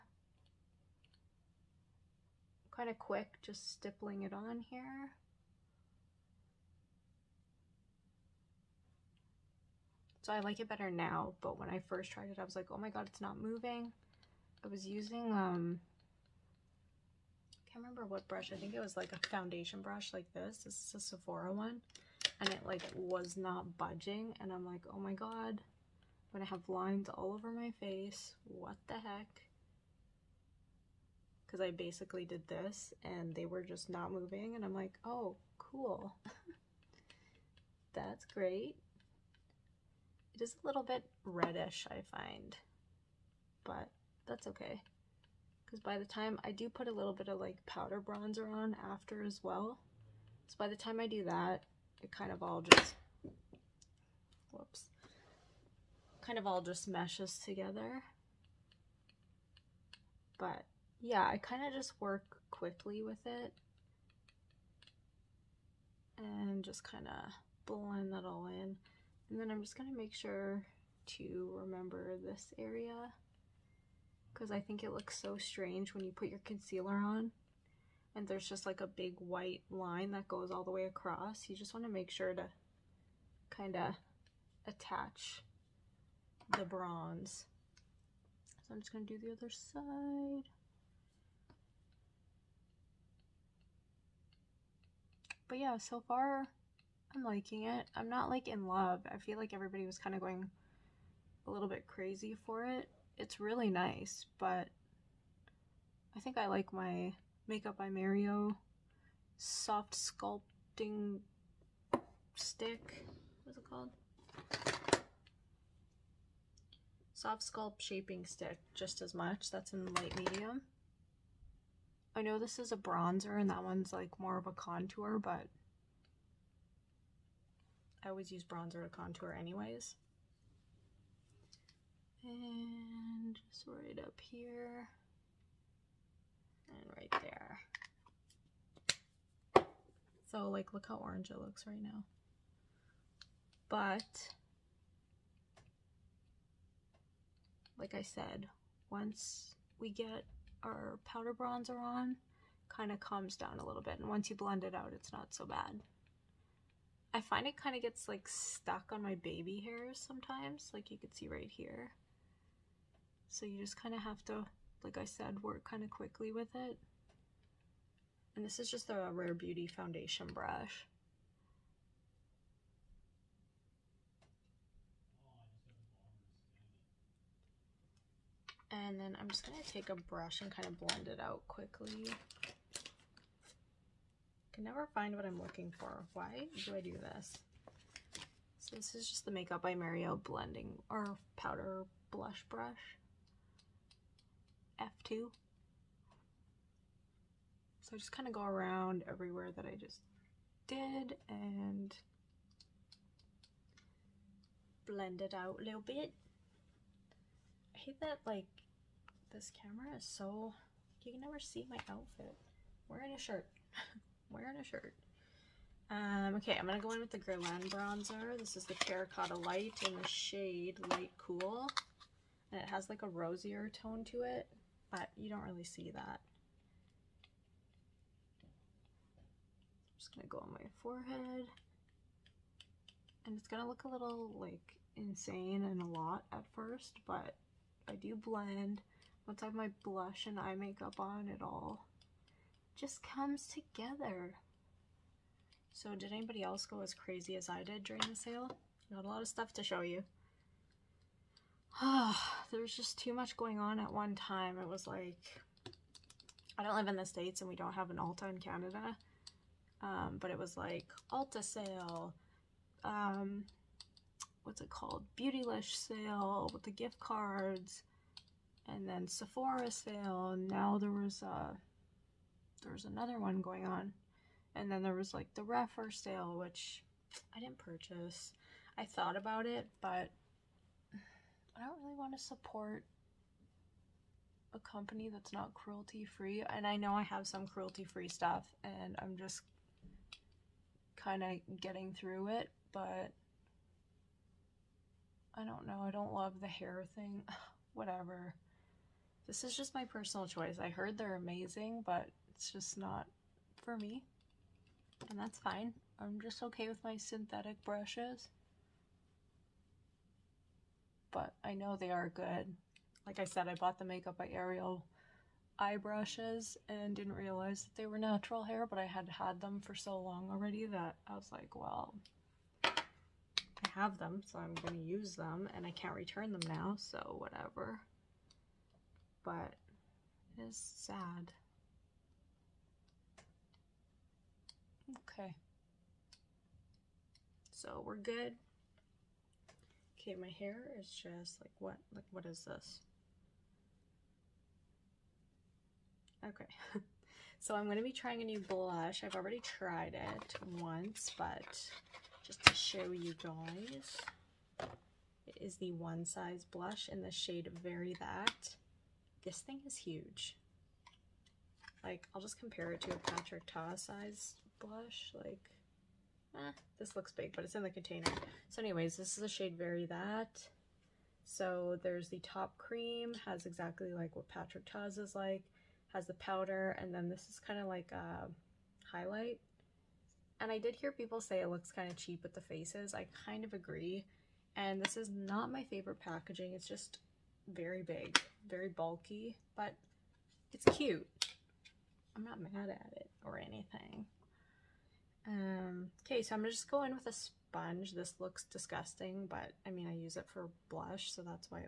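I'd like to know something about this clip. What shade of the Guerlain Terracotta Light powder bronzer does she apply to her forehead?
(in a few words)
Light Cool.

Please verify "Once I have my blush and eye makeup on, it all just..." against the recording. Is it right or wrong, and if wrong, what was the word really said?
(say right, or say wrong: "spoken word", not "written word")
right.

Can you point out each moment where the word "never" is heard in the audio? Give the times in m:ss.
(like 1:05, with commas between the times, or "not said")
3:04, 3:31.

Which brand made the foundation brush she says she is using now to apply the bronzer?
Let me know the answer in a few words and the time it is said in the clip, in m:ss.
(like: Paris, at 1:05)
Rare Beauty, at 2:49.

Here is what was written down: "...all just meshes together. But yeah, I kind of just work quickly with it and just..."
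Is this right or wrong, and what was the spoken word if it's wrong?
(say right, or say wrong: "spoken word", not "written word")
right.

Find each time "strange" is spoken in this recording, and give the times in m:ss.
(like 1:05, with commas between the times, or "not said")
1:15.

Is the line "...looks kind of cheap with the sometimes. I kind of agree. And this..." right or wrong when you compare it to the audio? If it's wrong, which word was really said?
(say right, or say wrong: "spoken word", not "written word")
wrong: "faces", not "sometimes".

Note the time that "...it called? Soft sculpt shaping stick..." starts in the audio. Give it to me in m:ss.
1:53.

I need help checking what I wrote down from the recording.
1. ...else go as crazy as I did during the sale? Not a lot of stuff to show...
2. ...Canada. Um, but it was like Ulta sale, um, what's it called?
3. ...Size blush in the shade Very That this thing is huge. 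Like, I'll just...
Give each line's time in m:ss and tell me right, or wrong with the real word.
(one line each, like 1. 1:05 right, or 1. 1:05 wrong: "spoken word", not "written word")
1. 4:06 right
2. 4:18 right
3. 5:56 right.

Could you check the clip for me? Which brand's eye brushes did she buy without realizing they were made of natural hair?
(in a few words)
Makeup by Ariel.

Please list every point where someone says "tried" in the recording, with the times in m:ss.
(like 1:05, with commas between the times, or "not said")
0:12, 5:49.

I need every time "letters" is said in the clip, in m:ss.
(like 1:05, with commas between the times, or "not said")
not said.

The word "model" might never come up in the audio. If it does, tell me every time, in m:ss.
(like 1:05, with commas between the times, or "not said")
not said.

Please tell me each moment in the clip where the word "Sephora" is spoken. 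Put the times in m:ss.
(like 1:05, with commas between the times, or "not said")
0:20, 4:29.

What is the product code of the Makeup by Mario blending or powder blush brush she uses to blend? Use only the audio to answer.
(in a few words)
F2.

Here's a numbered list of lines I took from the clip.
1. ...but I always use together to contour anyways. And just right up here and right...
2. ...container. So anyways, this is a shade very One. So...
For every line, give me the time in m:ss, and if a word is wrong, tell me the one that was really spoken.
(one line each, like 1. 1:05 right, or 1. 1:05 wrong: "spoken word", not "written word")
1. 2:05 wrong: "bronzer", not "together"
2. 6:07 wrong: "That", not "One".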